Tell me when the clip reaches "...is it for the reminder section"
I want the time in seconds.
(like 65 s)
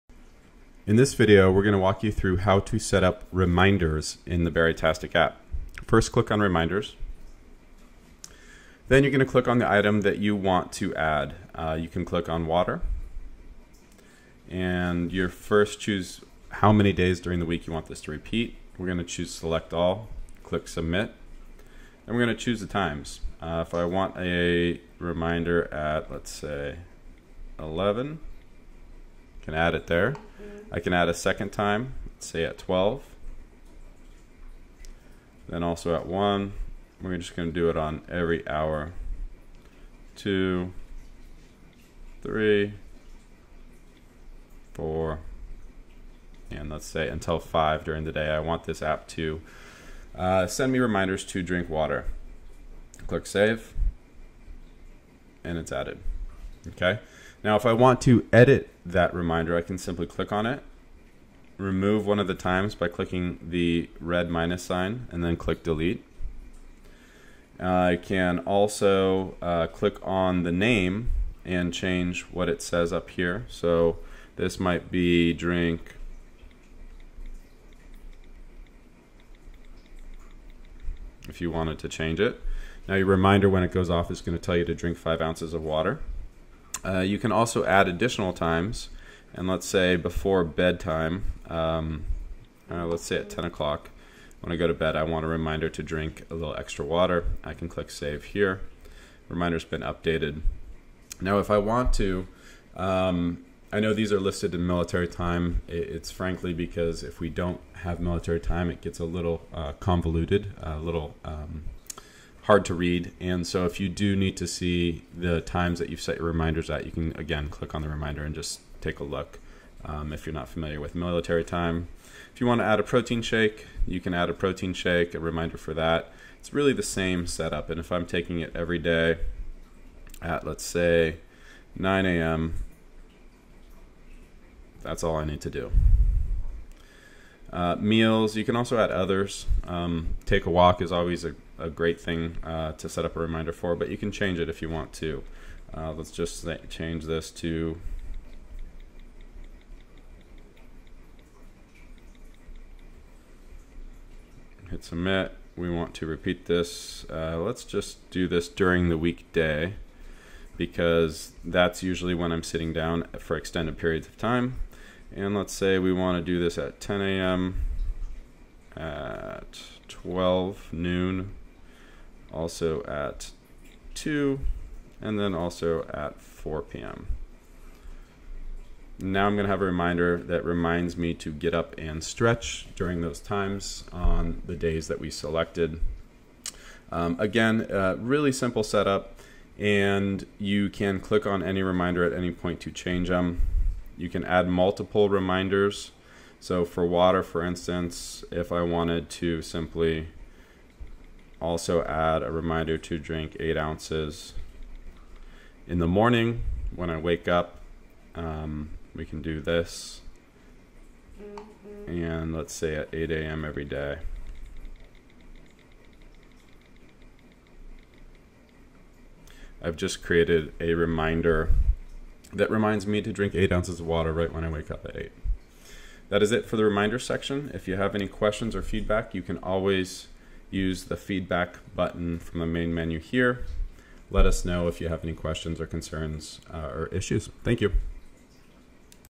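226 s.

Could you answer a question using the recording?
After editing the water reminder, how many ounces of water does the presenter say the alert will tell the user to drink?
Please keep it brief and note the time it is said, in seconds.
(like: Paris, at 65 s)
5 ounces, at 84 s.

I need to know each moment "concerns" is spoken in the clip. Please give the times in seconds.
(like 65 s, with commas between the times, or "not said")
235 s.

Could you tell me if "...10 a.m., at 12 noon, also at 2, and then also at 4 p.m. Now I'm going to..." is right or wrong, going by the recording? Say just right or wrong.
right.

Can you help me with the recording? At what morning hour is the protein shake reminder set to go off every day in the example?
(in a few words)
9 a.m.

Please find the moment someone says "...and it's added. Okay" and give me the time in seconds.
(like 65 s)
55 s.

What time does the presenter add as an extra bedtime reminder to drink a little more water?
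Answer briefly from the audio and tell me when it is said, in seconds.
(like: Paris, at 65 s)
10 o'clock, at 93 s.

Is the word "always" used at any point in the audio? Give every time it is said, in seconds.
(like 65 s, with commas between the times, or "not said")
140 s, 229 s.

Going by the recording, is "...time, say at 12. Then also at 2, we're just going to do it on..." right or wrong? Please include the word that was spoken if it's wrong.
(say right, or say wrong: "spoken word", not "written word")
wrong: "1", not "2".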